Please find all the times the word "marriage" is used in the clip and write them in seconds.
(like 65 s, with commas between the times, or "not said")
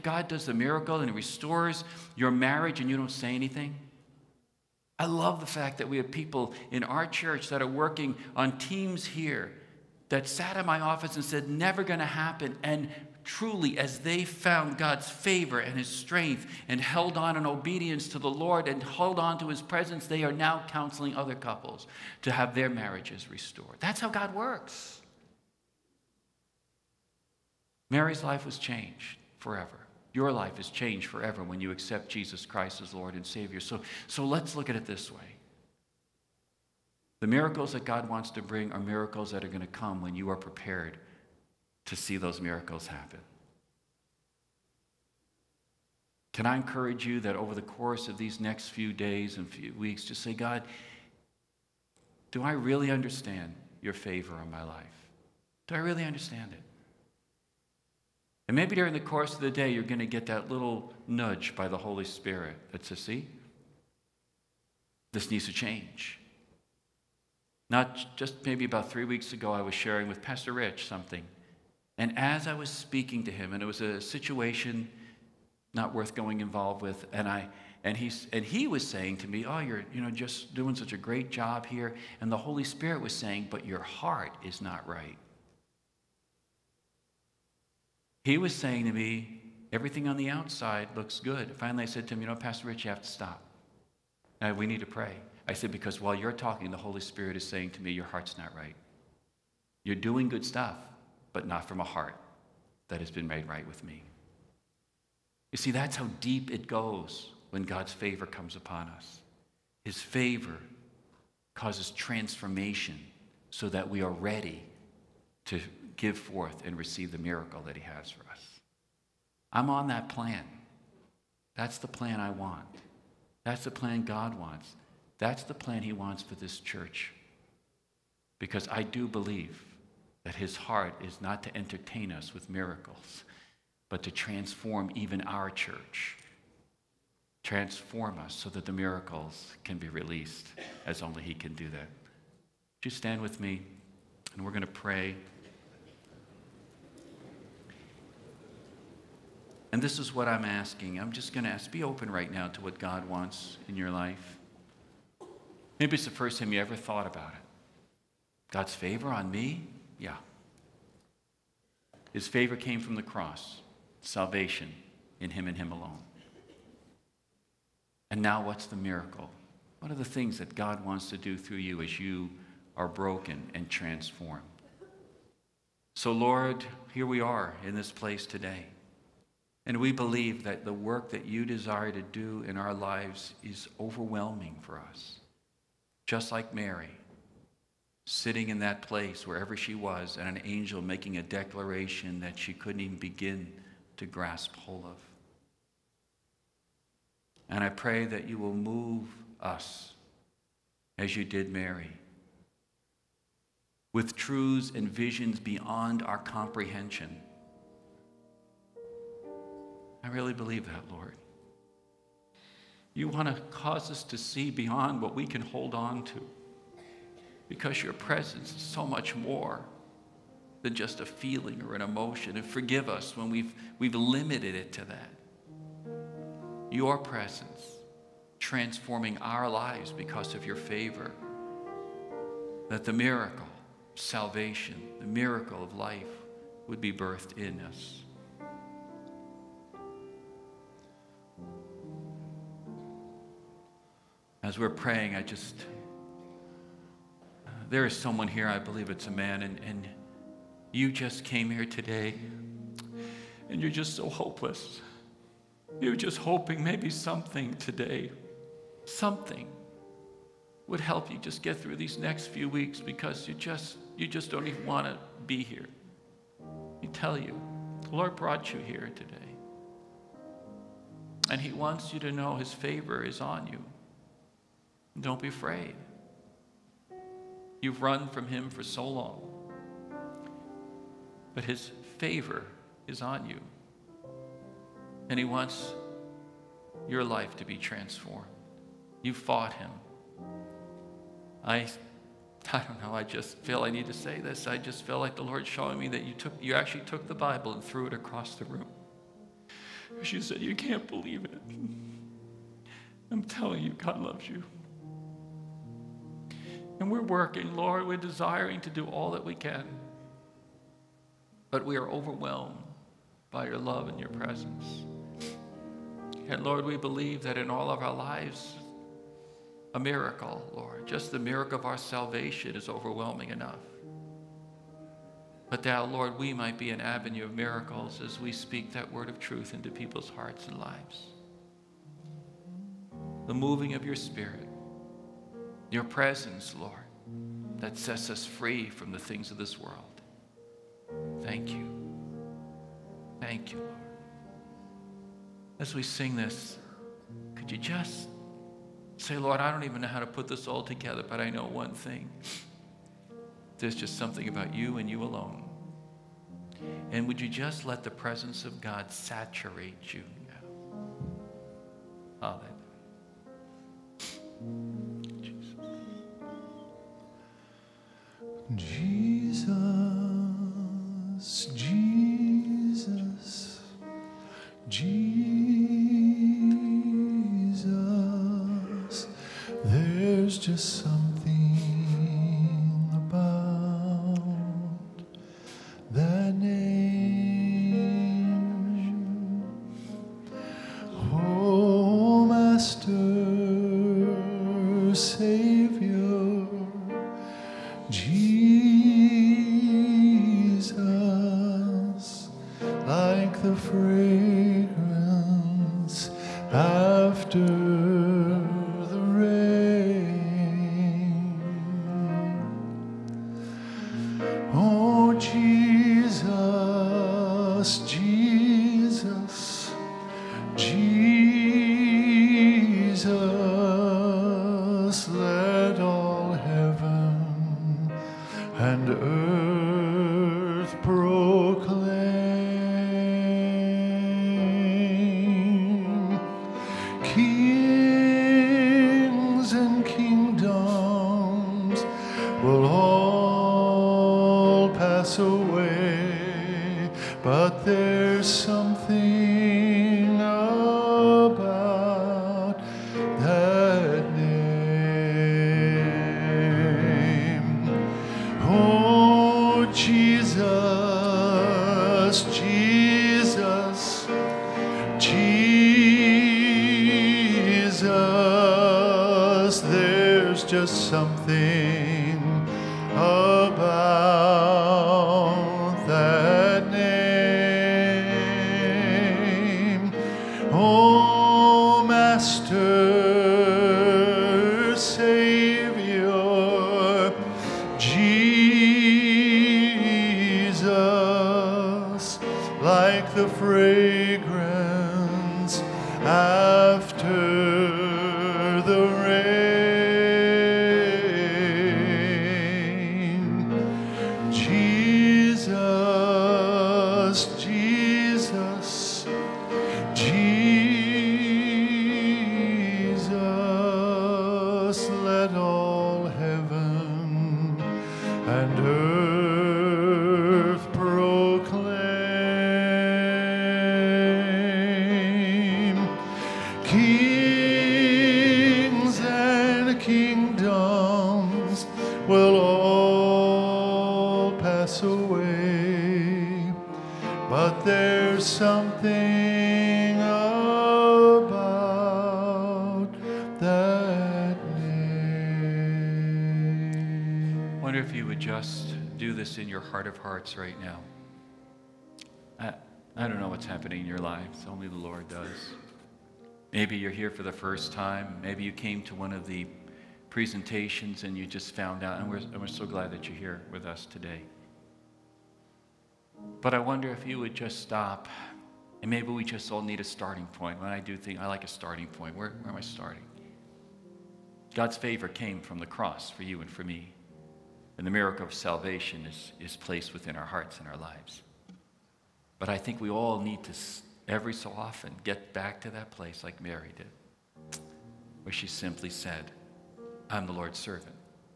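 2 s, 22 s.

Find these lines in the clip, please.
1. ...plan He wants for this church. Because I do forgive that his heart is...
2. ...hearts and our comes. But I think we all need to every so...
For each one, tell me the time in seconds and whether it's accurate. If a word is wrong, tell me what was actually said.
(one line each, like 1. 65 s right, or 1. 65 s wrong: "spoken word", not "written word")
1. 125 s wrong: "believe", not "forgive"
2. 580 s wrong: "lives", not "comes".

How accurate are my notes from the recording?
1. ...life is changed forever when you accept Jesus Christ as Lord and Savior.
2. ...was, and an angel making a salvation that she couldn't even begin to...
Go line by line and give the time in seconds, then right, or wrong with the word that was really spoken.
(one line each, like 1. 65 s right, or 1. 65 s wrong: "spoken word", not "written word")
1. 30 s right
2. 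189 s wrong: "declaration", not "salvation".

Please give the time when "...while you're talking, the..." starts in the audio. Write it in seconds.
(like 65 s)
95 s.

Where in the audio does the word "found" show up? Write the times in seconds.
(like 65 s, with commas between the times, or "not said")
14 s, 561 s.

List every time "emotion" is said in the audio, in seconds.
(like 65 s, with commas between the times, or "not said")
221 s.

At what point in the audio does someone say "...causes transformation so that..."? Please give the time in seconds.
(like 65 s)
111 s.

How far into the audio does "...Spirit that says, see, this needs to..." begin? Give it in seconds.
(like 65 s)
62 s.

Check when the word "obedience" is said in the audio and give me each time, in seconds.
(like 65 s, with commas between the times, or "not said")
17 s.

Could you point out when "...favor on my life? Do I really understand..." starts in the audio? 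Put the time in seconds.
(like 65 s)
53 s.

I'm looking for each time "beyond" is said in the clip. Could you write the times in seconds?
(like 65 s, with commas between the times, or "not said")
205 s, 214 s.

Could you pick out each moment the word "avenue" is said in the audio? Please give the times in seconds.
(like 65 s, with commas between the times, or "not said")
326 s.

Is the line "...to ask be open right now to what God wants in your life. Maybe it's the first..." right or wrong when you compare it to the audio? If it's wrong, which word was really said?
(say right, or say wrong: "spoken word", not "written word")
right.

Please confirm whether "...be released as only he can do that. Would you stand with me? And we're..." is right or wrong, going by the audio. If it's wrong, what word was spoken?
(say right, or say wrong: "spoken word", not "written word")
right.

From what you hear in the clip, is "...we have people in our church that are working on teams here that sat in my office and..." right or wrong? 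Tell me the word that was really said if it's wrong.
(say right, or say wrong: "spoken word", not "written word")
right.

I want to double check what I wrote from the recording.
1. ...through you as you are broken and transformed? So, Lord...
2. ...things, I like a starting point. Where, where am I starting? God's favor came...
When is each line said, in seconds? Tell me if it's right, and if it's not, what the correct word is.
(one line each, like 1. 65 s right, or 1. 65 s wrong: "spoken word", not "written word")
1. 171 s right
2. 570 s right.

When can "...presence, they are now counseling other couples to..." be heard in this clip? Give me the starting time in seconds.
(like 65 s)
19 s.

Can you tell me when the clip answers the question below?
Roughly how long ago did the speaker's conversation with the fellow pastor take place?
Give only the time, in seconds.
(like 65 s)
68 s.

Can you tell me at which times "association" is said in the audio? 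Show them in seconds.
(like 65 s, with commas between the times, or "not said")
not said.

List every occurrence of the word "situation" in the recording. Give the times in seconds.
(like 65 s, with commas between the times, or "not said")
73 s.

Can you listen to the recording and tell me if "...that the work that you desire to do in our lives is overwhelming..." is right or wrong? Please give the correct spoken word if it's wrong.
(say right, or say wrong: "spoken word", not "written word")
right.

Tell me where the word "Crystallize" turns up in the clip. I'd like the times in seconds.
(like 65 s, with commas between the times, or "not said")
not said.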